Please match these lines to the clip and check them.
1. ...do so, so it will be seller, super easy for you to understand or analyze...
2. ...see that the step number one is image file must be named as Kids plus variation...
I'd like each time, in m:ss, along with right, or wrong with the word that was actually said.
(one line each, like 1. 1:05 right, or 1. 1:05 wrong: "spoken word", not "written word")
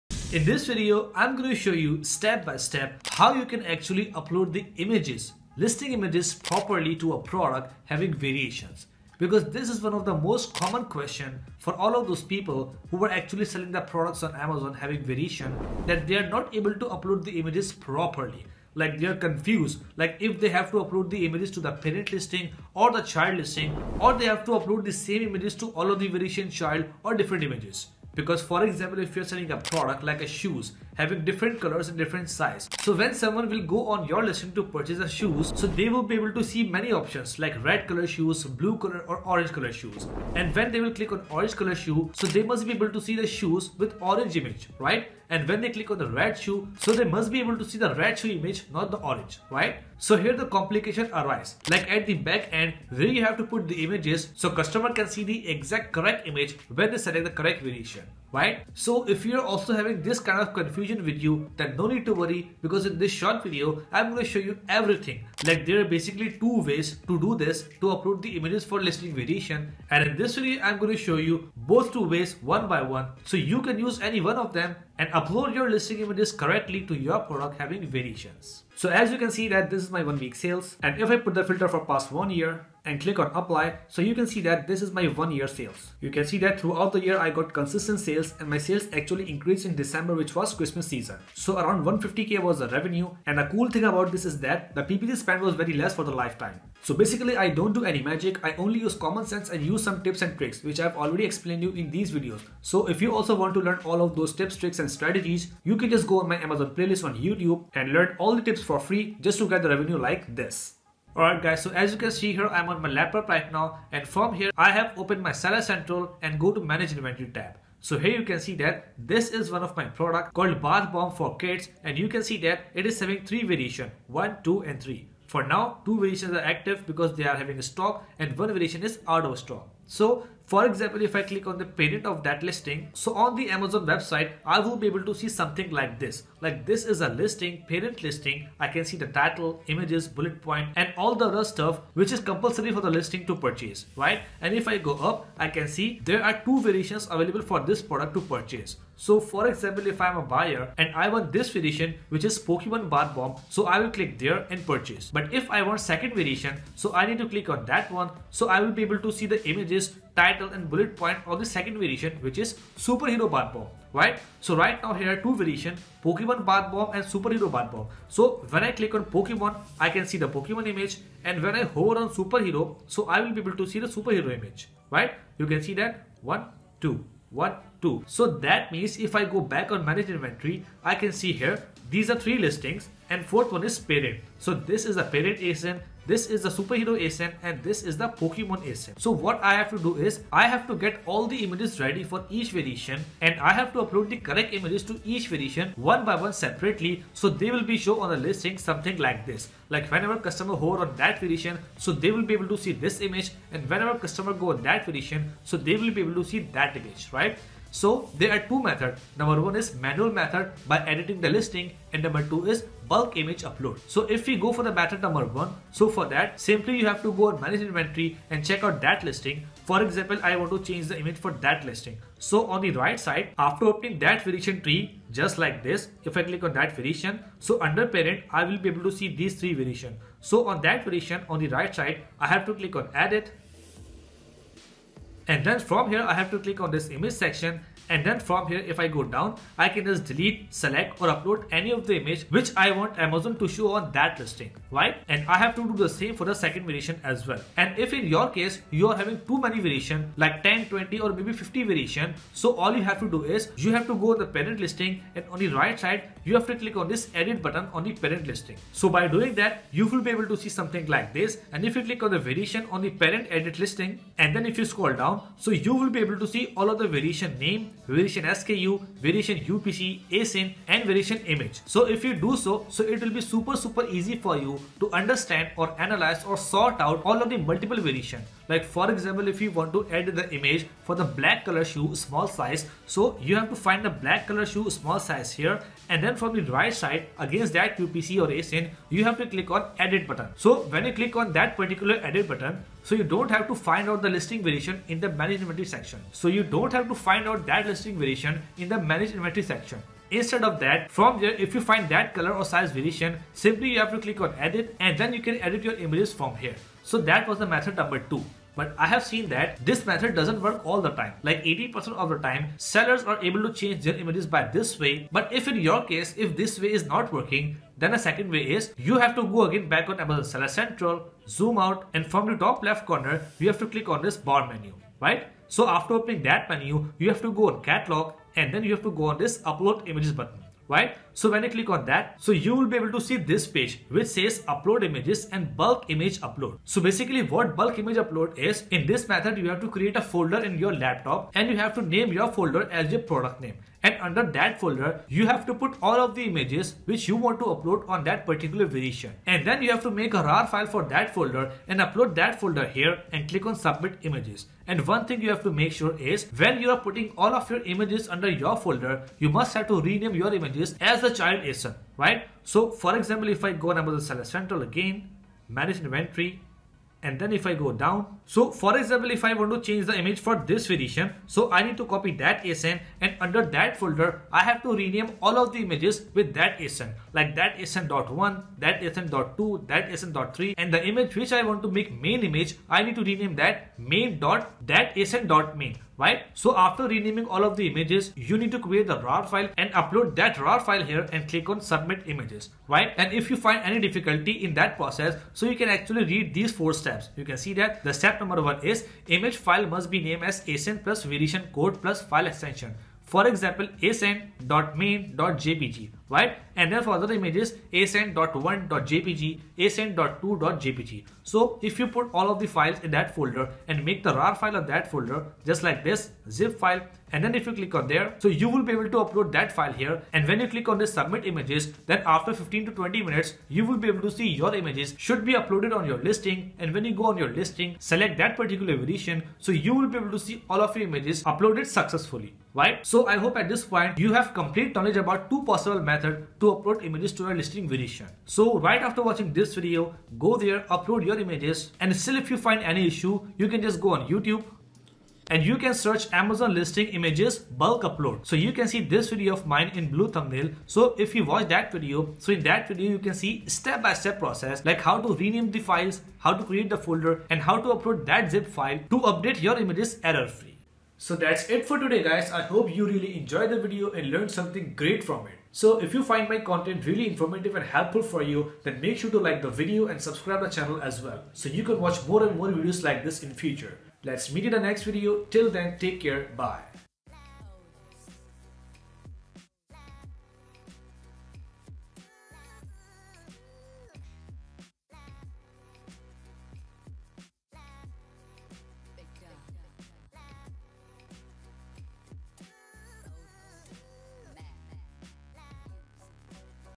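1. 4:32 wrong: "super", not "seller"
2. 6:37 wrong: "ASIN", not "Kids".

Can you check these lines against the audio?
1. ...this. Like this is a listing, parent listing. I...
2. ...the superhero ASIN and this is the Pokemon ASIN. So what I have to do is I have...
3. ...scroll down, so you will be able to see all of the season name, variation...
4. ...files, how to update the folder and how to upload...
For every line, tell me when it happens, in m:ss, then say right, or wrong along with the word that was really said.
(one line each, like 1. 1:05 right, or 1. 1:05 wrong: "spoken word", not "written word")
1. 2:15 right
2. 3:06 right
3. 4:24 wrong: "variation", not "season"
4. 7:35 wrong: "create", not "update".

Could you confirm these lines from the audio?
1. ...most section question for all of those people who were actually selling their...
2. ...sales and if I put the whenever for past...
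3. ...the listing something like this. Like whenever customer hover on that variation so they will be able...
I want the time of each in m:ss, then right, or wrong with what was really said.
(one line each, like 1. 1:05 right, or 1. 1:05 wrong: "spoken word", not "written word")
1. 0:10 wrong: "common", not "section"
2. 1:20 wrong: "filter", not "whenever"
3. 3:18 right.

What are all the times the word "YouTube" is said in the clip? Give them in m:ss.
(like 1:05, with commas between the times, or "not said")
1:47, 7:24.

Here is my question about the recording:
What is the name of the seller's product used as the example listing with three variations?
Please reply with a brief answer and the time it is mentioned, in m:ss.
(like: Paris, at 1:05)
Bath Bomb for Kids, at 2:00.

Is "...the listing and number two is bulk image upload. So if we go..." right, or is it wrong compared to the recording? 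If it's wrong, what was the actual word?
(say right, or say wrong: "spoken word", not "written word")
right.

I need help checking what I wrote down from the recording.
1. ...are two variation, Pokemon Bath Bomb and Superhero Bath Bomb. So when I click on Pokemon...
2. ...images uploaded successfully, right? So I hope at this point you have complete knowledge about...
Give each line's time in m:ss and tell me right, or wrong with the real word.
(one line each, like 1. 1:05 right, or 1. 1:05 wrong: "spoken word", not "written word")
1. 2:45 right
2. 7:10 right.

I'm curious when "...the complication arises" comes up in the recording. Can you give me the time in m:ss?
0:50.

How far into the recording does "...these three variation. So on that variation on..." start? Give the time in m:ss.
3:49.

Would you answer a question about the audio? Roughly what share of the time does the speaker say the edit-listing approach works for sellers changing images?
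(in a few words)
80%.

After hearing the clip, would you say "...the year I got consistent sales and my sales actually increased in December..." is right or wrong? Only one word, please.
right.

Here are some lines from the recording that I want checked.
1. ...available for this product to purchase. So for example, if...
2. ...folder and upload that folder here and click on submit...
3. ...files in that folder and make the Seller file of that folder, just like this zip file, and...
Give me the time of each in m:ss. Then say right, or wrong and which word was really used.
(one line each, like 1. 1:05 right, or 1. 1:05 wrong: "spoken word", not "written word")
1. 2:27 right
2. 5:51 right
3. 6:52 wrong: "RAR", not "Seller".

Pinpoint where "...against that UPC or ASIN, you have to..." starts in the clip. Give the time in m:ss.
4:47.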